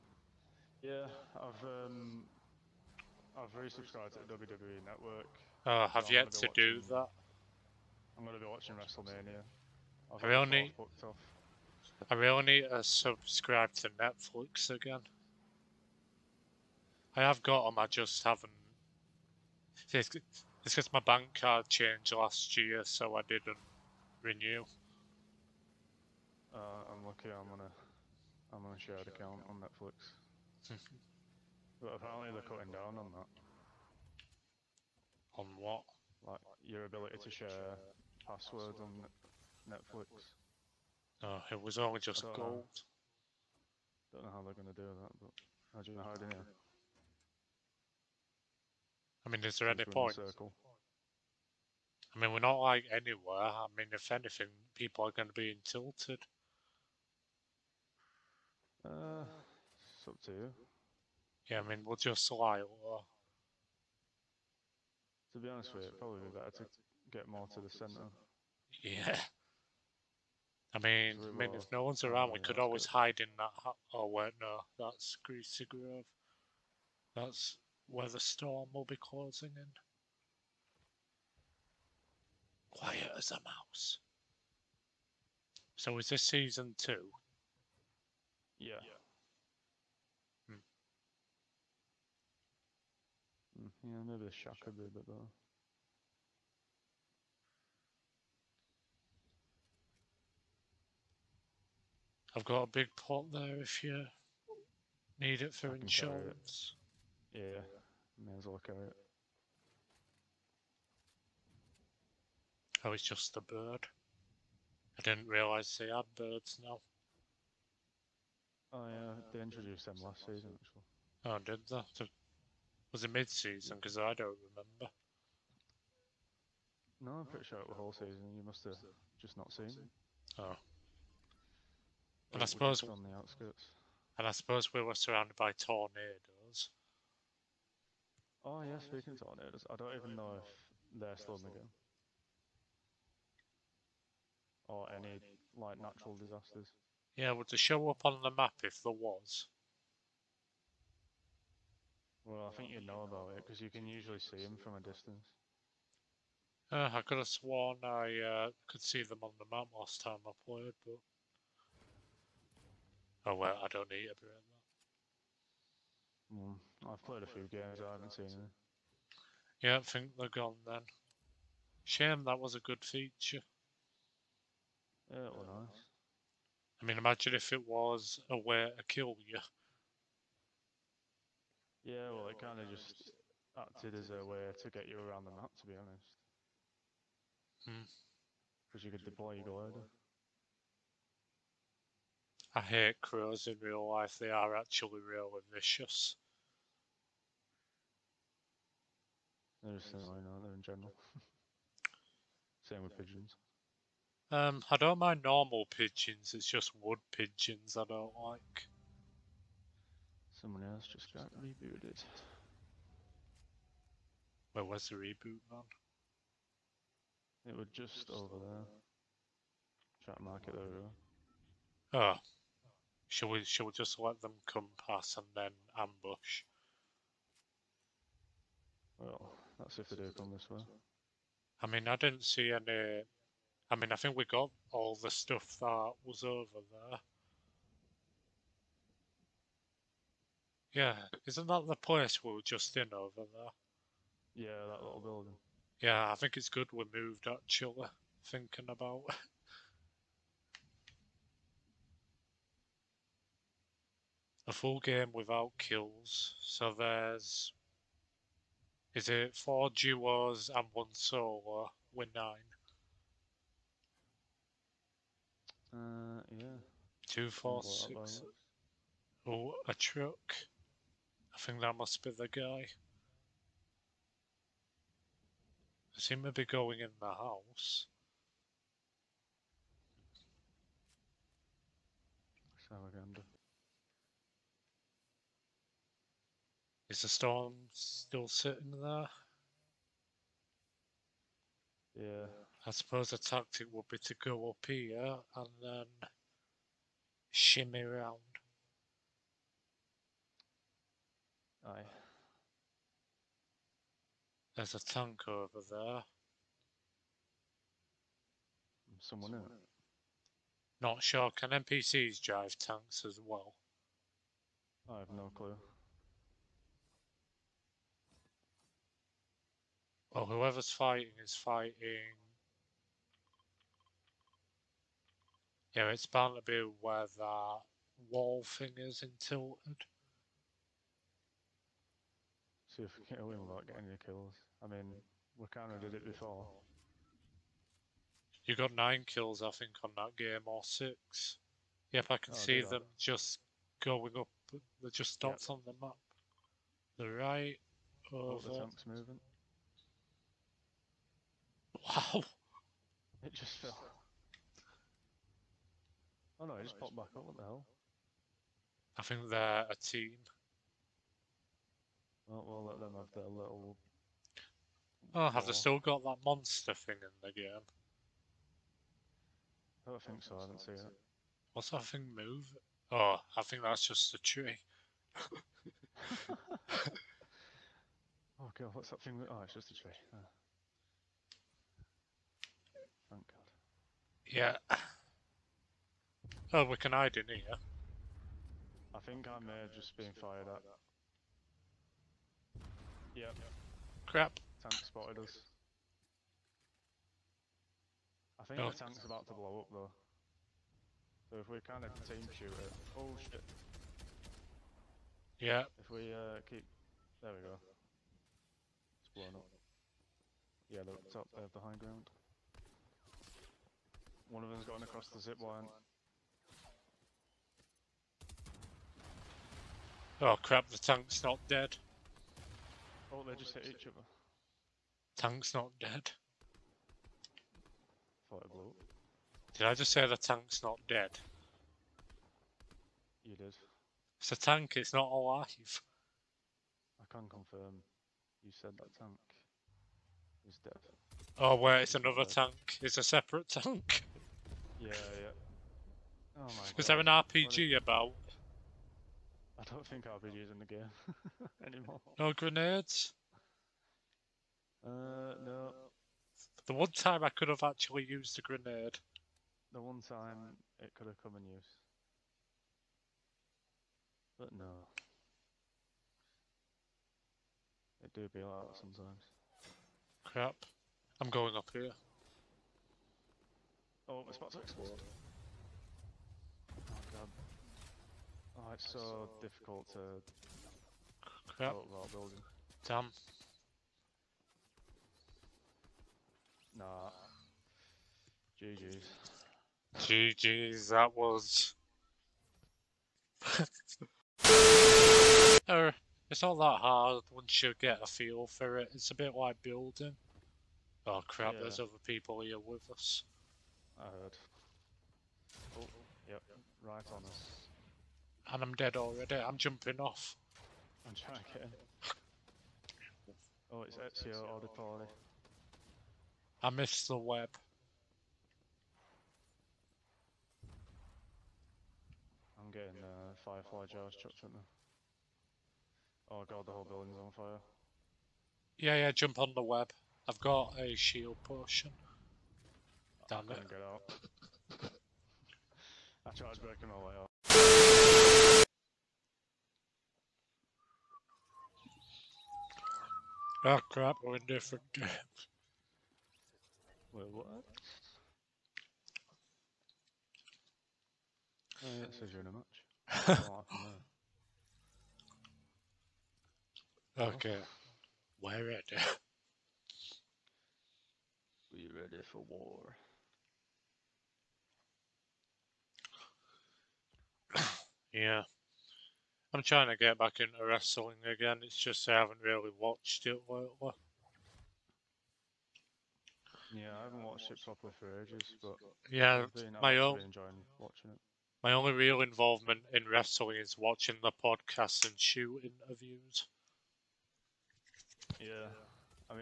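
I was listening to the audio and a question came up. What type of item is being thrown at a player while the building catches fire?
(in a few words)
firefly jars.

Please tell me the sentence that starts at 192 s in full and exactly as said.
I hate crows in real life, they are actually really vicious.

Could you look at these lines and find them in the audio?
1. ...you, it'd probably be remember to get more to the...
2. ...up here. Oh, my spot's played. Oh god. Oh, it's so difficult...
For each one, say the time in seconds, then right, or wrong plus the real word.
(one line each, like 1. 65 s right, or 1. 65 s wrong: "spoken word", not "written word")
1. 65 s wrong: "better", not "remember"
2. 471 s wrong: "exploded", not "played".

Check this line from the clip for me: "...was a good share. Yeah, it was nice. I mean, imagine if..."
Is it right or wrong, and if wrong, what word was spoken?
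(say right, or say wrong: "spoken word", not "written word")
wrong: "feature", not "share".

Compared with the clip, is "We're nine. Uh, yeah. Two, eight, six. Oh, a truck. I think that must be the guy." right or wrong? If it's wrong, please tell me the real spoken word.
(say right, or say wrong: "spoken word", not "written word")
wrong: "four", not "eight".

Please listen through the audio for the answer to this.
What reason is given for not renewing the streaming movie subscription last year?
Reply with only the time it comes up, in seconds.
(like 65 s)
20 s.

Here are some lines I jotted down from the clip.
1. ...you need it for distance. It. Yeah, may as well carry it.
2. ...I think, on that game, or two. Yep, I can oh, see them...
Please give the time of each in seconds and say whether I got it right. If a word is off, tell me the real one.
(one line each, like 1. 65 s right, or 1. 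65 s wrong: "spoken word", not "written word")
1. 103 s wrong: "insurance", not "distance"
2. 339 s wrong: "six", not "two".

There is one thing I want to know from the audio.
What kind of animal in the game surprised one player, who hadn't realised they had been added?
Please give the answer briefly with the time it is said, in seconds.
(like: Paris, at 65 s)
bird, at 113 s.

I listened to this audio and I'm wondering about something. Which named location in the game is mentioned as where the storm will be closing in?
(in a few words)
Greasy Grove.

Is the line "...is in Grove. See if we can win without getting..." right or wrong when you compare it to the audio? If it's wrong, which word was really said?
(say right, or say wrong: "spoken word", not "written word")
wrong: "Tilted", not "Grove".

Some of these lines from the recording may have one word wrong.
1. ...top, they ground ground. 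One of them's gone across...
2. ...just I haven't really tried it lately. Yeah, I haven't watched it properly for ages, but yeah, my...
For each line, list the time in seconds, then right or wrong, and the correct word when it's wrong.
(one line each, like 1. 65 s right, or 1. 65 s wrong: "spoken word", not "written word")
1. 411 s wrong: "behind", not "ground"
2. 571 s wrong: "watched", not "tried".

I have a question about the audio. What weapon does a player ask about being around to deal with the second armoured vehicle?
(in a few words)
RPG.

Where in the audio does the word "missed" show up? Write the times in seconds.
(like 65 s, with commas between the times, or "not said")
516 s.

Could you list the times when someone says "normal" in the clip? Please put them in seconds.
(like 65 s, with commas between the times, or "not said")
205 s.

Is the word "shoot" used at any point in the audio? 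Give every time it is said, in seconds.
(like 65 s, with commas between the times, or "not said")
402 s, 585 s.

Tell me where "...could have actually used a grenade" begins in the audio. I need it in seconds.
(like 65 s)
457 s.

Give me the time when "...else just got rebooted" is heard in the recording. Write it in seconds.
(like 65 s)
210 s.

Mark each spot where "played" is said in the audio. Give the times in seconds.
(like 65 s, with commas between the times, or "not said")
160 s, 167 s.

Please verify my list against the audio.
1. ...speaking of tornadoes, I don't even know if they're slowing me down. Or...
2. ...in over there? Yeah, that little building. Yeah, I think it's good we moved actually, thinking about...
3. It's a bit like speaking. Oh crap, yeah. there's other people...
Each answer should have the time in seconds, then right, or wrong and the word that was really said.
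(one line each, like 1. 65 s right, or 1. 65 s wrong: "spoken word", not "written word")
1. 138 s right
2. 242 s right
3. 498 s wrong: "building", not "speaking".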